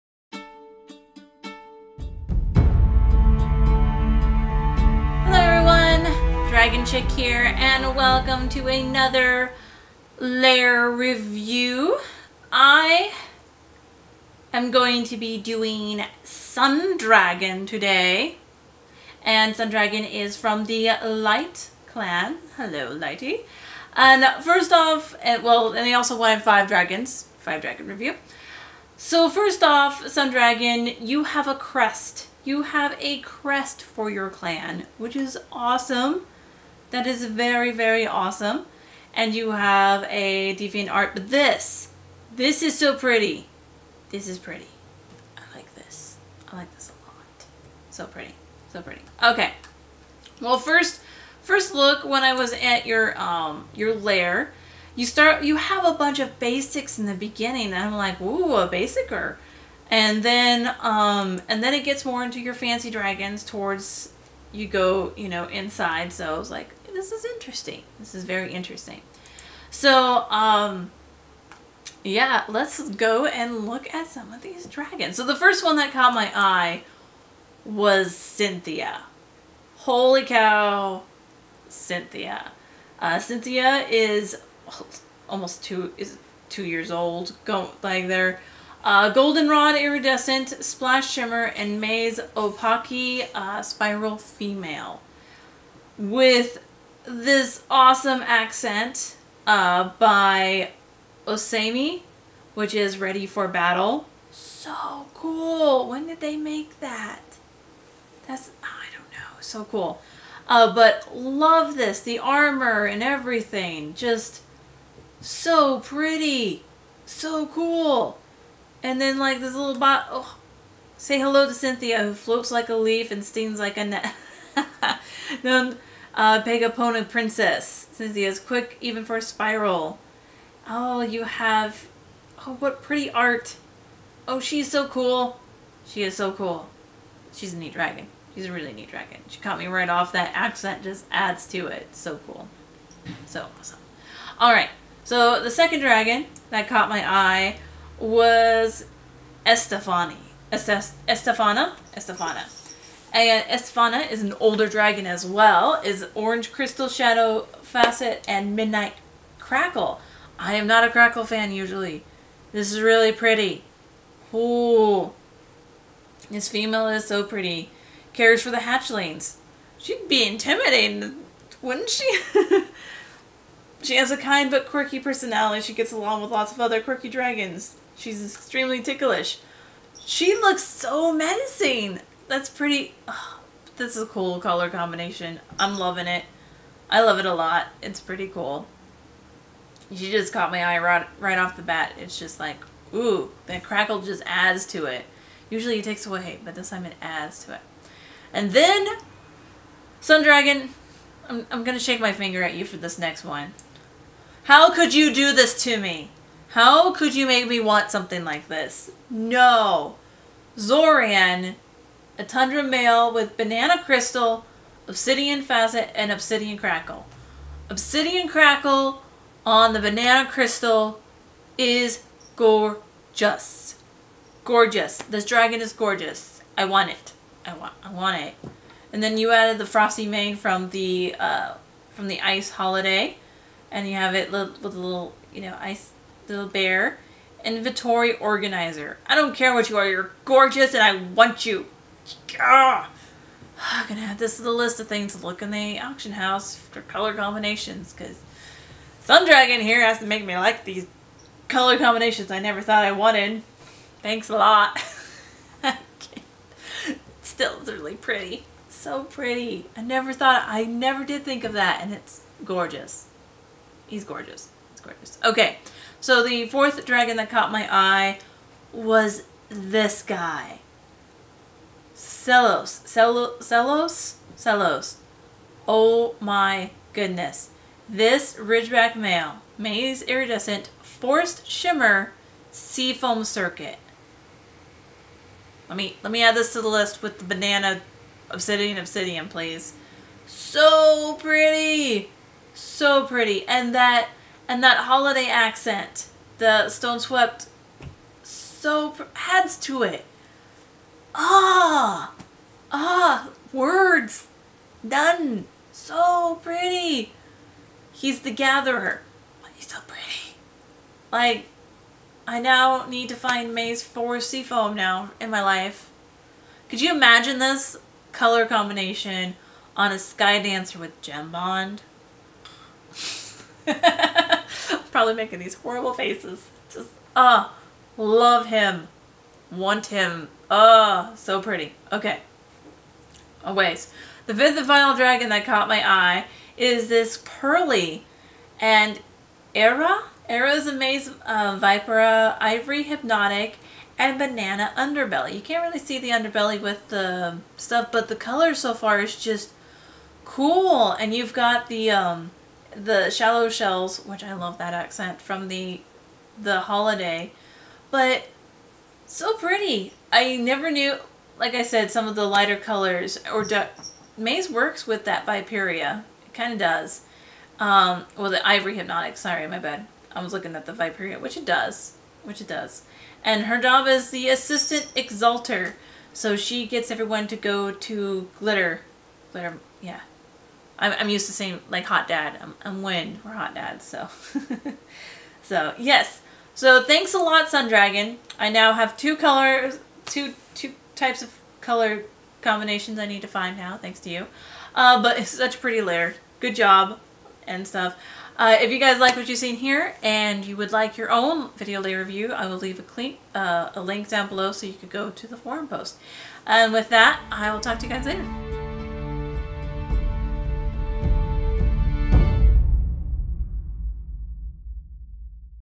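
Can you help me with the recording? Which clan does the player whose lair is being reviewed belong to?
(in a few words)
Light clan.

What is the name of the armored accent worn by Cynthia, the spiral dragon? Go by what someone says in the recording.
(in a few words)
Ready for Battle.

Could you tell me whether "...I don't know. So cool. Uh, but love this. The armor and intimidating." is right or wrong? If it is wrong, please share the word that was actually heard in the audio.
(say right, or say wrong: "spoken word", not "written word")
wrong: "everything", not "intimidating".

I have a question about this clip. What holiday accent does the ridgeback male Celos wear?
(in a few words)
stone swept.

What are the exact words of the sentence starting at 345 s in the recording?
You can't really see the underbelly with the stuff, but the color so far is just cool.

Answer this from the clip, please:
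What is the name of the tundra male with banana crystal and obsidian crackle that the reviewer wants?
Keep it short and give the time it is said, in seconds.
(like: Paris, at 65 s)
Zorian, at 210 s.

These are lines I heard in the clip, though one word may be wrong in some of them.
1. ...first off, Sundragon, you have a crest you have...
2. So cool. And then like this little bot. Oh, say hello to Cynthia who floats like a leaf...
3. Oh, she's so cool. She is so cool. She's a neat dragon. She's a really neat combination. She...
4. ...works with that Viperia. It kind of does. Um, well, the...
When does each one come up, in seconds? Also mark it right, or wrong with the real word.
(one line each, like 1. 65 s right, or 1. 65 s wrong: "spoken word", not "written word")
1. 29 s right
2. 117 s right
3. 134 s wrong: "dragon", not "combination"
4. 364 s right.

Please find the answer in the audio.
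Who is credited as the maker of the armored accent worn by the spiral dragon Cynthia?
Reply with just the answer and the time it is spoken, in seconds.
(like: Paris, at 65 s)
Osami, at 101 s.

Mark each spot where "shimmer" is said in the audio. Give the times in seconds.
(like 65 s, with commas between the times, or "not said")
91 s, 281 s.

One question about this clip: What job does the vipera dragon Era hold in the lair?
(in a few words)
Assistant Exalter.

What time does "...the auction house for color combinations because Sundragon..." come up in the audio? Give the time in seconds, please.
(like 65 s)
245 s.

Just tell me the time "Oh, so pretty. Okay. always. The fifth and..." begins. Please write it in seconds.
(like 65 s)
330 s.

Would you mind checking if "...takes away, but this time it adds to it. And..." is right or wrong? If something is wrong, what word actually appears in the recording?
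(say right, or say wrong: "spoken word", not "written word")
right.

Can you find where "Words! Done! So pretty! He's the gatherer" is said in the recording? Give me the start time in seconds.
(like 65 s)
303 s.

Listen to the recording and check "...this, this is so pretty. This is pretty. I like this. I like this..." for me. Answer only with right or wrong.
right.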